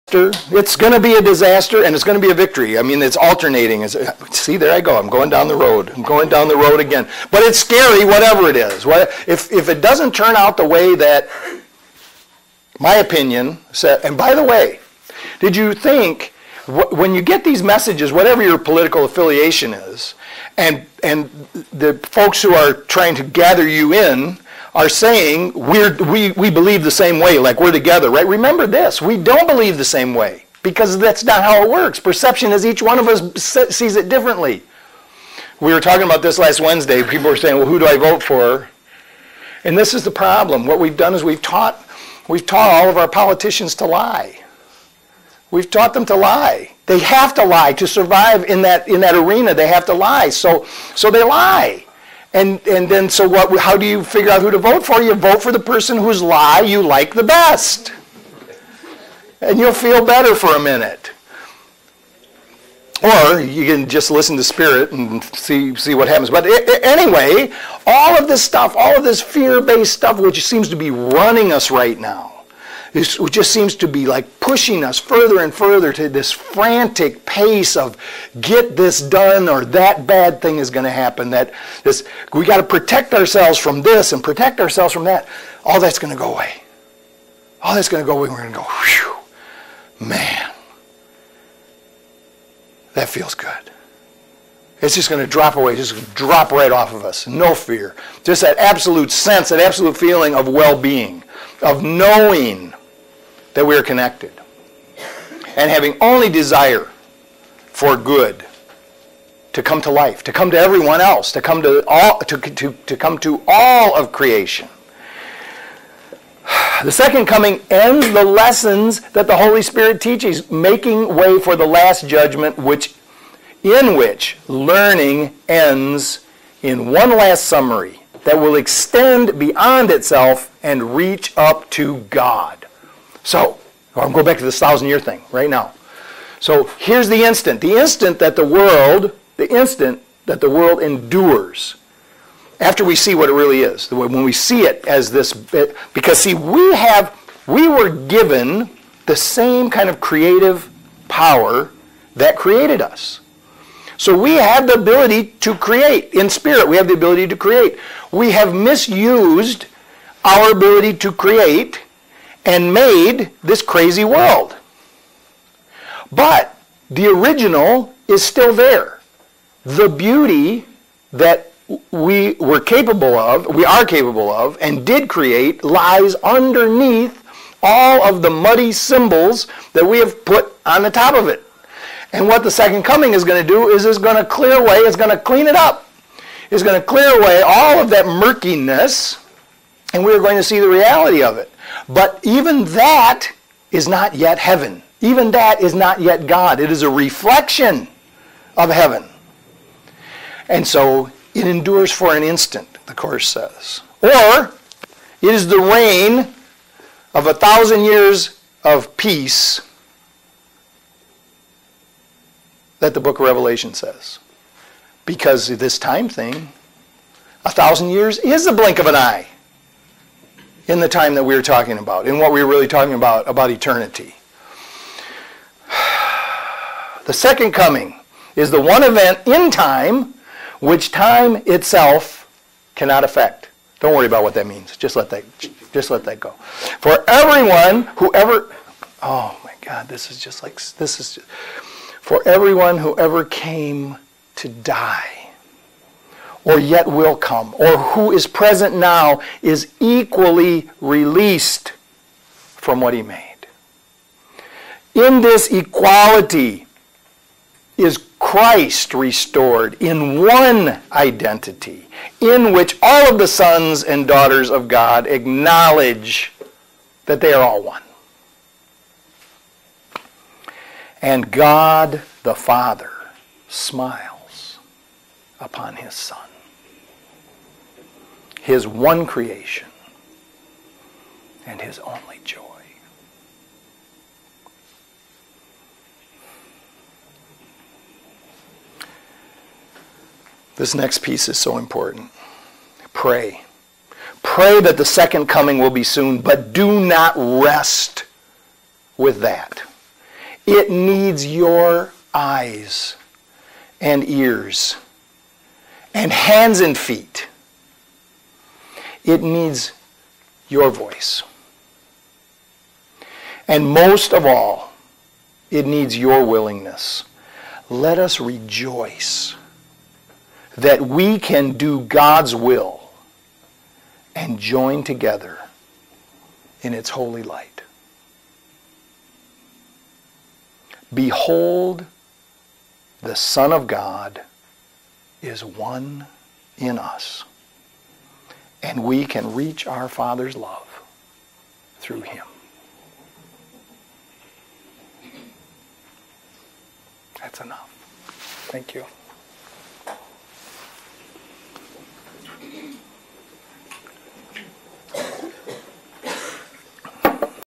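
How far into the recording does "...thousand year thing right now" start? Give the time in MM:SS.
02:14.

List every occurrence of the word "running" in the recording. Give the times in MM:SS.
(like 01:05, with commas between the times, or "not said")
01:10.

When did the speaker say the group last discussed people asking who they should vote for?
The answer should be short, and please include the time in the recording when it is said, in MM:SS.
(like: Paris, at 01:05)
Last Wednesday, at 00:36.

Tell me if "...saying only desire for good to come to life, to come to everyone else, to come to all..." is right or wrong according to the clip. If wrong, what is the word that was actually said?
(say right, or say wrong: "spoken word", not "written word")
wrong: "having", not "saying".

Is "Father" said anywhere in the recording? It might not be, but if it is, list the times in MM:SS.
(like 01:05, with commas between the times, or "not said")
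04:32, 05:39.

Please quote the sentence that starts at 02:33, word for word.
So we have the ability to create.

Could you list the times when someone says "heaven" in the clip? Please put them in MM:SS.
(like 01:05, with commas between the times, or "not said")
03:14, 03:18.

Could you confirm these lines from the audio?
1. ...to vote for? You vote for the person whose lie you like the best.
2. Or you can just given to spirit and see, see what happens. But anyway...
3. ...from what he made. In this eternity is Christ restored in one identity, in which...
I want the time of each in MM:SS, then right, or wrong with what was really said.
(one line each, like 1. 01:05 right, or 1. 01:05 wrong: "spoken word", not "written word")
1. 00:54 right
2. 01:03 wrong: "listen", not "given"
3. 04:12 wrong: "equality", not "eternity".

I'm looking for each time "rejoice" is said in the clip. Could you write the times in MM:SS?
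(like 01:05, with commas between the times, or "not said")
05:18.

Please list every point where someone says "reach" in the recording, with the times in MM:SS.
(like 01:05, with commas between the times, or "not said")
02:10, 05:39.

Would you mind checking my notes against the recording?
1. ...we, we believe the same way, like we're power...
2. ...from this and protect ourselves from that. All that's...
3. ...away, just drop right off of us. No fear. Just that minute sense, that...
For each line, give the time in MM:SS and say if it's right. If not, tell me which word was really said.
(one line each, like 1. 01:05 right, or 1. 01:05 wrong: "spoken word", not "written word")
1. 00:26 wrong: "together", not "power"
2. 01:23 right
3. 01:35 wrong: "absolute", not "minute".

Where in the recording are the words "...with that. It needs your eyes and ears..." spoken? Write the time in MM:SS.
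04:58.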